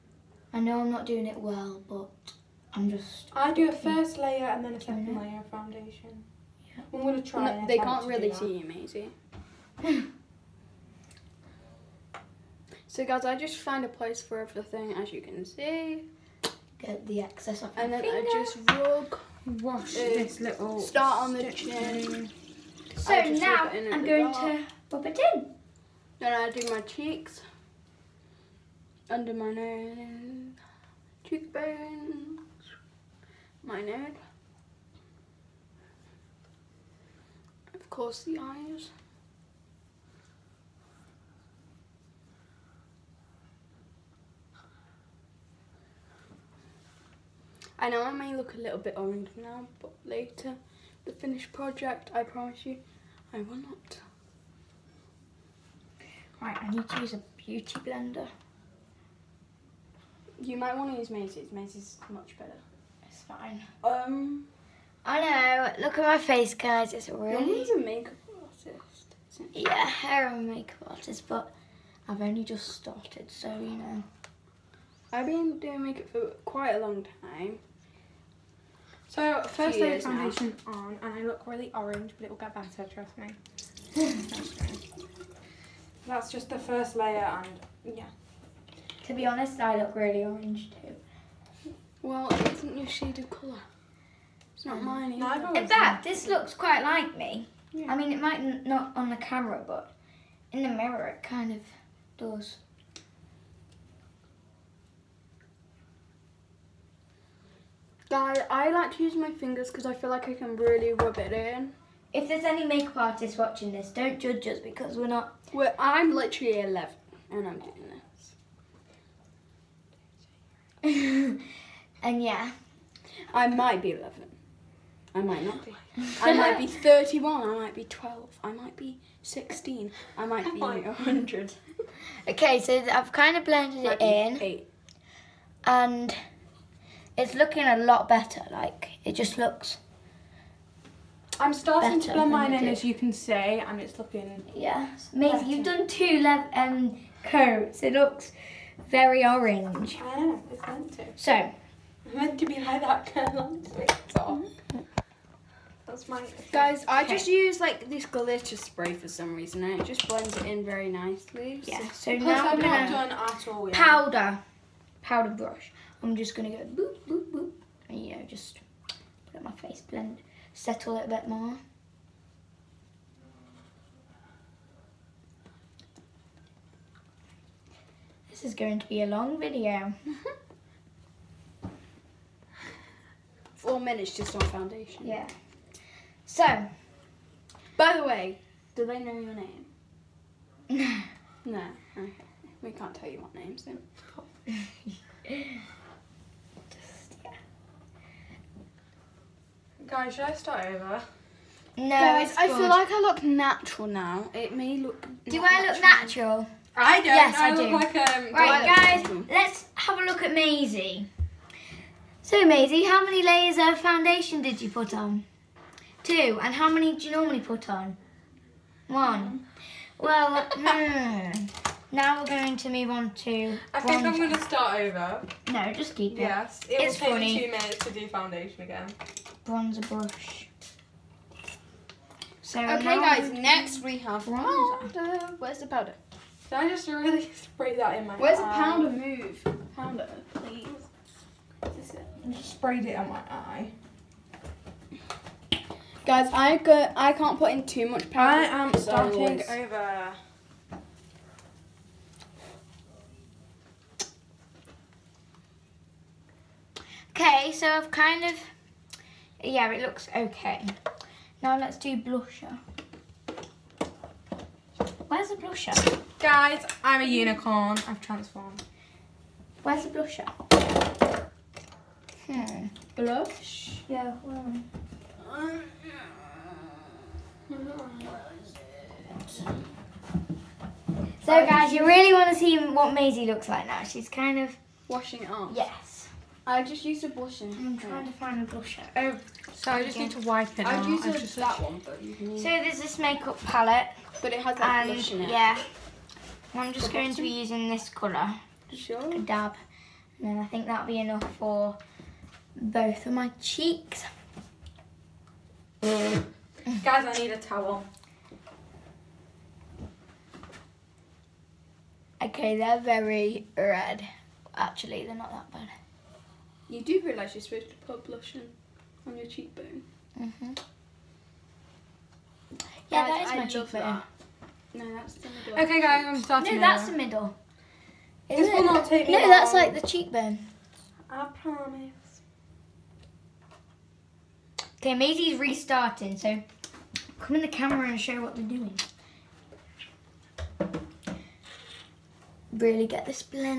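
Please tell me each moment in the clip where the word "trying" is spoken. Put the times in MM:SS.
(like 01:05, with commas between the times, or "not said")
04:47.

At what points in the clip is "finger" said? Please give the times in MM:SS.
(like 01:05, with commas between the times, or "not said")
00:18, 01:49.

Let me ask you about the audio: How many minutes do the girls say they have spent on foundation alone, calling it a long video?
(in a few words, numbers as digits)
4.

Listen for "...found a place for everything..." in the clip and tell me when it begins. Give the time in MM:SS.
00:13.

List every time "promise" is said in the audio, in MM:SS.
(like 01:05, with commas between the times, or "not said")
00:52, 05:31.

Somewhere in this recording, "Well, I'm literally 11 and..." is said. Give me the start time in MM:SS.
01:55.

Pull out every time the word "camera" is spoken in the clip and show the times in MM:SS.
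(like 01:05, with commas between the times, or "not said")
01:39, 05:37.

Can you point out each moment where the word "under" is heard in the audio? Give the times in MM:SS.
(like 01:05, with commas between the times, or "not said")
00:29.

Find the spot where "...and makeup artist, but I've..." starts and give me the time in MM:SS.
01:10.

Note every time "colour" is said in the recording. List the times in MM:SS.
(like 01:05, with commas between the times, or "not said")
01:33, 04:57.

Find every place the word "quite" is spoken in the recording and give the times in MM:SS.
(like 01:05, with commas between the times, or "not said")
01:16, 01:36.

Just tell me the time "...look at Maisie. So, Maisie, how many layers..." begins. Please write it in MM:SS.
03:30.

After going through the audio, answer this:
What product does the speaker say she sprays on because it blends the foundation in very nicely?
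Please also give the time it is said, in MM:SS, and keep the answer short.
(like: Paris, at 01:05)
glitter spray, at 02:38.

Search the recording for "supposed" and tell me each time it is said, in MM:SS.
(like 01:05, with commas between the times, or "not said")
05:17.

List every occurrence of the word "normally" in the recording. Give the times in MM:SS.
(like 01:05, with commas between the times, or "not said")
03:37.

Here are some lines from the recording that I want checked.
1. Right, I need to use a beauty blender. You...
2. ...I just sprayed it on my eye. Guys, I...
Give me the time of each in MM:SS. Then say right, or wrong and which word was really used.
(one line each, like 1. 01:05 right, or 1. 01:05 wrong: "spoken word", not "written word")
1. 00:56 right
2. 04:02 right.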